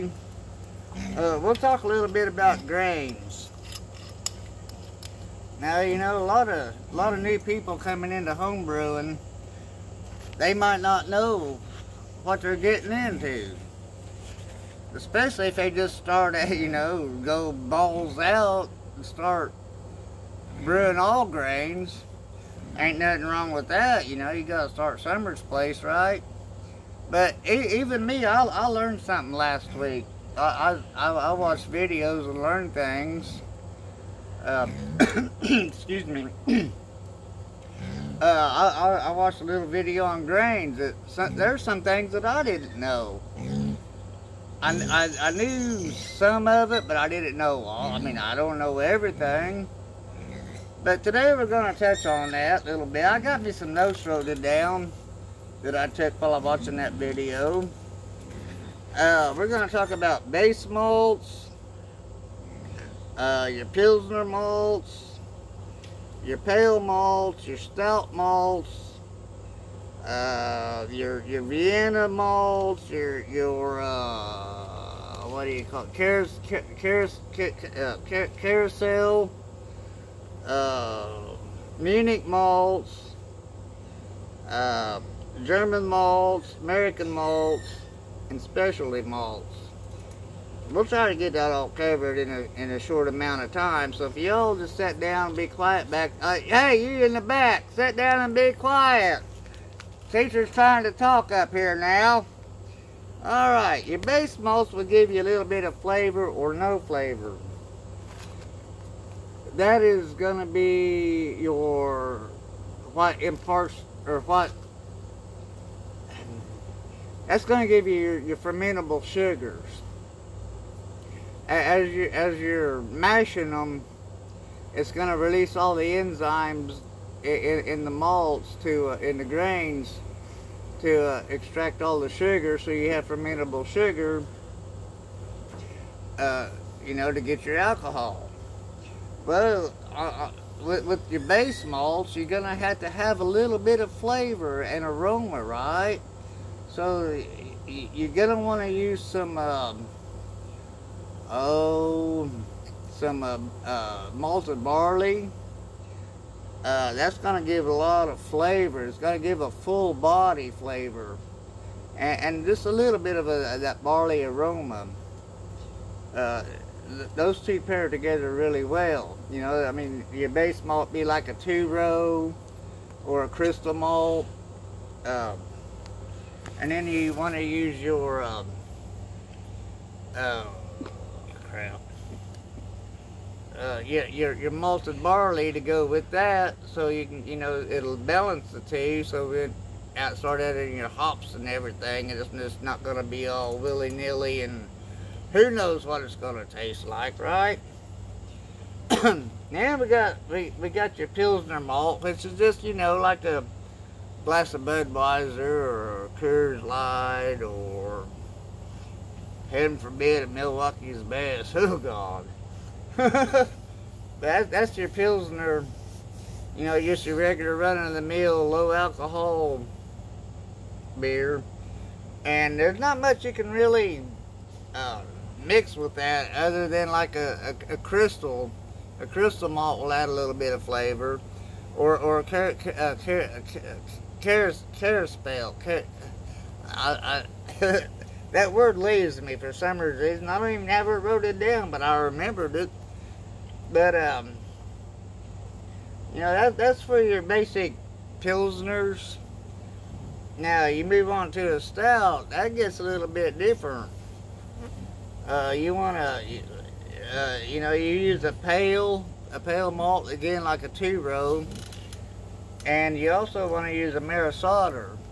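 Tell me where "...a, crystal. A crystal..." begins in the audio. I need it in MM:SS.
03:47.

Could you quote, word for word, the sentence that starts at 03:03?
Uh, yeah, your your malted barley to go with that, so you can you know it'll balance the two.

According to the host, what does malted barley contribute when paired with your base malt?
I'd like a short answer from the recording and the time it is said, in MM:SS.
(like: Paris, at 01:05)
barley aroma, at 02:43.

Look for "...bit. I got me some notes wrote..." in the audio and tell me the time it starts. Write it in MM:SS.
00:52.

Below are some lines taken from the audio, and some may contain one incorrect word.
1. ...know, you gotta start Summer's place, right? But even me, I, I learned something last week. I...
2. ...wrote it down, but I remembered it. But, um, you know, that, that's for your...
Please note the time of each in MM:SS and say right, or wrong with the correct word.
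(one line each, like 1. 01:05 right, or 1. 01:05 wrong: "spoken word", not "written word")
1. 00:24 right
2. 04:00 right.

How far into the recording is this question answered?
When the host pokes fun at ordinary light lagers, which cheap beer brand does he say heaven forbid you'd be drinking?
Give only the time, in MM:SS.
03:30.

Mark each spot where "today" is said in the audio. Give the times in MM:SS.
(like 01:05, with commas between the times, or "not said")
00:51.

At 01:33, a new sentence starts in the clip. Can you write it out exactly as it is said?
So if y'all just sit down and be quiet back, uh, hey, you in the back, sit down and be quiet.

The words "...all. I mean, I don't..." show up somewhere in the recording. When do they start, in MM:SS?
00:47.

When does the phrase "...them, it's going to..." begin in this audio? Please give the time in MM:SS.
02:03.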